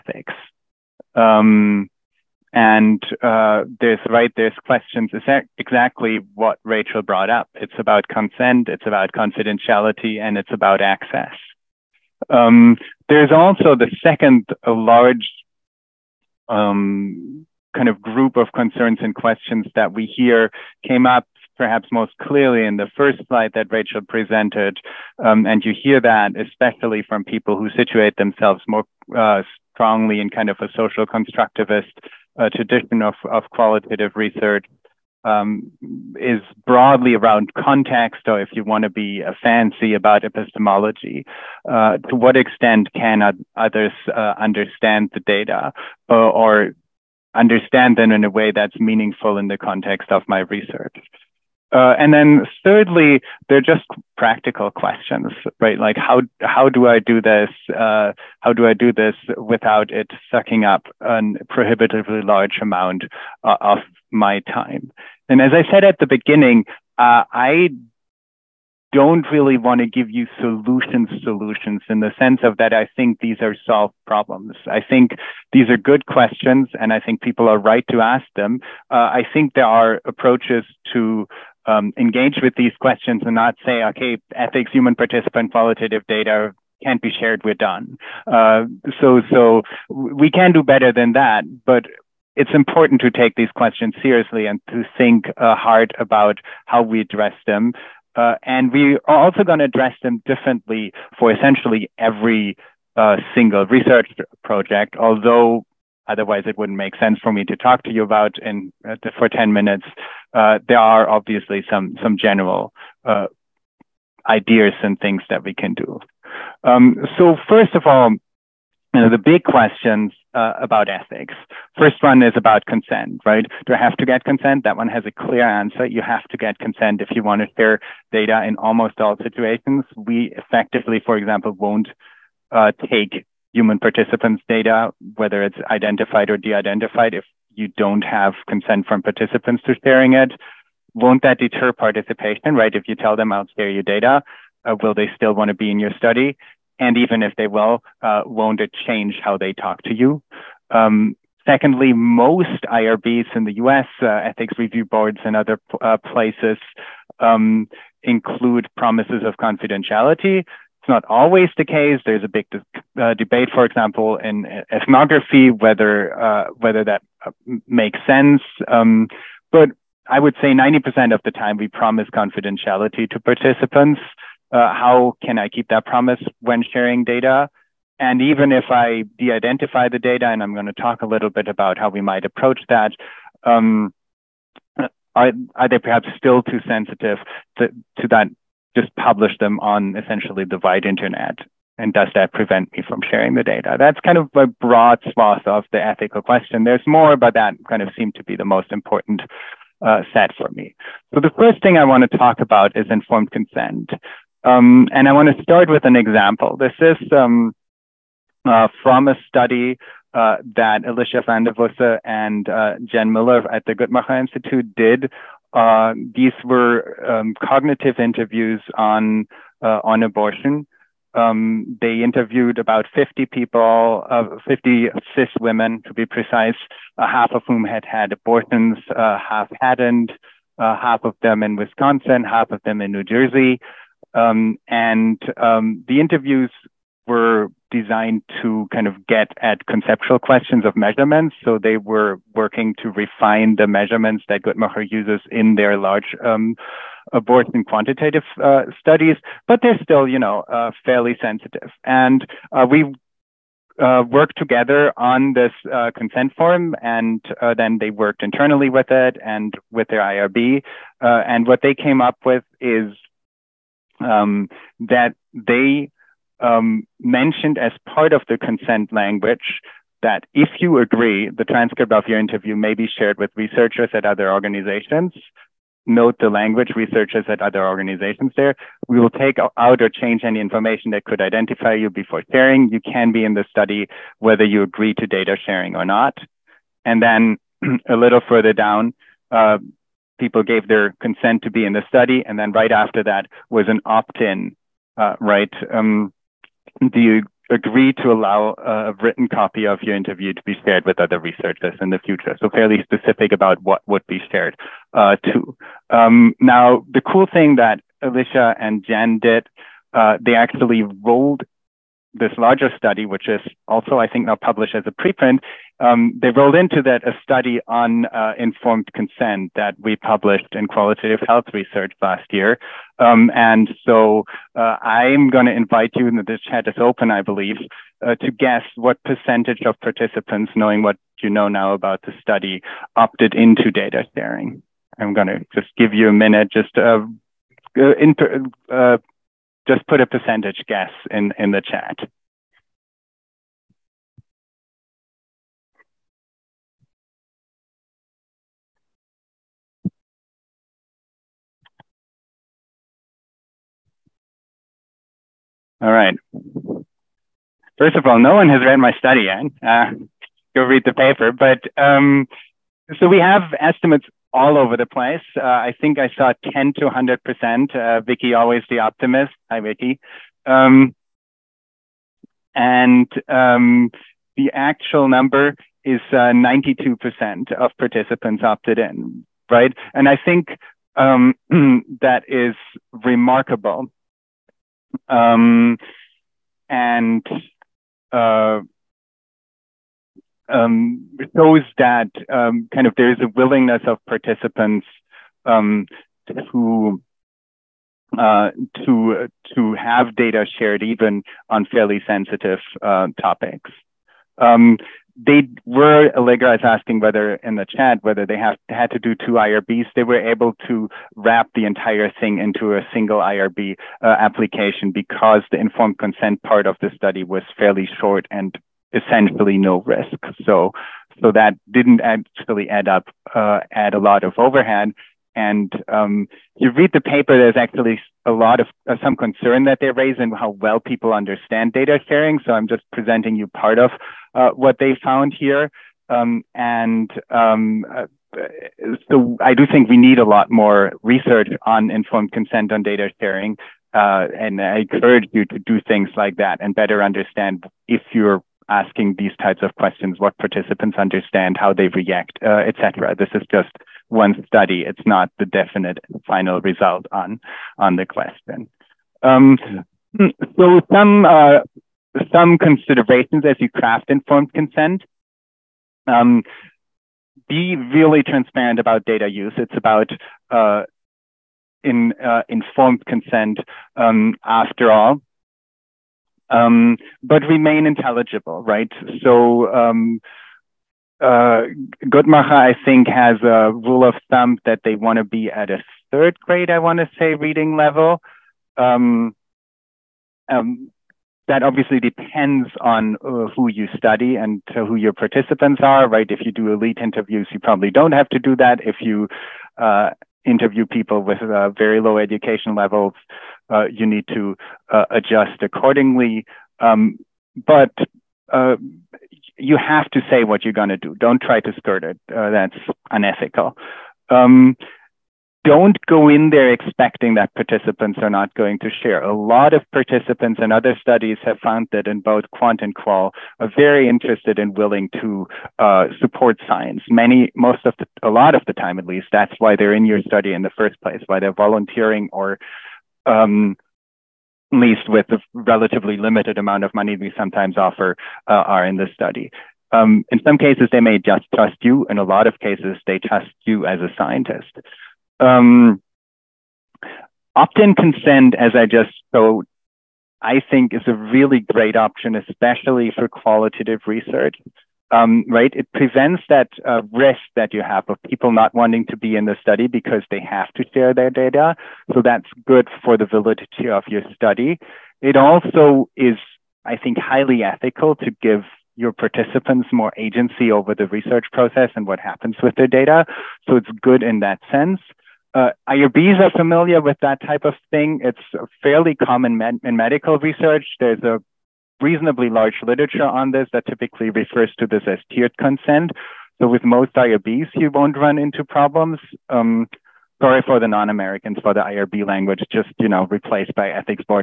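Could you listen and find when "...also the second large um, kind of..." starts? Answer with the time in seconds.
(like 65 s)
13 s.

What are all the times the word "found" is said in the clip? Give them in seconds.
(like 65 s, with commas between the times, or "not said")
435 s, 521 s.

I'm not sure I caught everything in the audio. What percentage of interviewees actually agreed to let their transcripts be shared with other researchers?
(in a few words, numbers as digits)
92%.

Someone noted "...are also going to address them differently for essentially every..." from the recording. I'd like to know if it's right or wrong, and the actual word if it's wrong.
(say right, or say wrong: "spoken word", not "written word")
right.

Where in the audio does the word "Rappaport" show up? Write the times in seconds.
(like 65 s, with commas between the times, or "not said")
not said.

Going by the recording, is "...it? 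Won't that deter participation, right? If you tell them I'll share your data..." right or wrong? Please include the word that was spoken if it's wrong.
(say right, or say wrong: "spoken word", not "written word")
right.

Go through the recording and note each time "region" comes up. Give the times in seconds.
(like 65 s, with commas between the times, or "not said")
not said.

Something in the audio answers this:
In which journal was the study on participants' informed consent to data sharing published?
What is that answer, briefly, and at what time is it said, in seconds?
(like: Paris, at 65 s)
Qualitative Health Research, at 320 s.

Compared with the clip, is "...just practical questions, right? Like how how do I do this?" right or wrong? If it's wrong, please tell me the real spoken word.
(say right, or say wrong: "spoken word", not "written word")
right.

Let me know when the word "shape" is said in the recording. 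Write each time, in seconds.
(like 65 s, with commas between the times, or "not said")
not said.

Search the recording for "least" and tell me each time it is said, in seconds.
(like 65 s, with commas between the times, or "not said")
529 s, 534 s.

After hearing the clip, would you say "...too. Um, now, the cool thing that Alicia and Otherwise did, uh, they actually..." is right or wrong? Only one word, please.
wrong.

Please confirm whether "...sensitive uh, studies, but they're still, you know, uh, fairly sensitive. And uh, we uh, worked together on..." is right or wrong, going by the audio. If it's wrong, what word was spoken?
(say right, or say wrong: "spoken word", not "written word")
wrong: "quantitative", not "sensitive".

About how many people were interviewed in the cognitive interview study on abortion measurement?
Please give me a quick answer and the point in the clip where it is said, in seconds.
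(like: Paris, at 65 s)
50, at 222 s.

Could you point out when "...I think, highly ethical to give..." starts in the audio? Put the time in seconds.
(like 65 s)
566 s.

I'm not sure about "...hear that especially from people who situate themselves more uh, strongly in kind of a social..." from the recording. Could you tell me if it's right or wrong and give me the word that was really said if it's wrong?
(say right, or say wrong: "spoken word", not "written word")
right.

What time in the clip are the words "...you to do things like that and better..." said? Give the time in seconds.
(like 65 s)
445 s.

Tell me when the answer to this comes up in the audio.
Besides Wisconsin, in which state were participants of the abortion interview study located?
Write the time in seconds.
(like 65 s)
232 s.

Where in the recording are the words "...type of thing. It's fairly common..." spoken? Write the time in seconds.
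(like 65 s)
577 s.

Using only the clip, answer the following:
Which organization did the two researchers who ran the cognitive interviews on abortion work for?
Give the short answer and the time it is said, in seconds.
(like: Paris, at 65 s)
Guttmacher Institute, at 213 s.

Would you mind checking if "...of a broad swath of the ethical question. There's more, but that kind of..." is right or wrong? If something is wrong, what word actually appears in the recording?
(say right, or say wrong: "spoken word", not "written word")
right.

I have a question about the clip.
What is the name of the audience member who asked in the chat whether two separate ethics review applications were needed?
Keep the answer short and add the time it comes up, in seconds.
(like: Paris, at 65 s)
Allegra, at 406 s.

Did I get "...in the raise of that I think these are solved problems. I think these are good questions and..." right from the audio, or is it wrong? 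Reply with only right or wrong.
wrong.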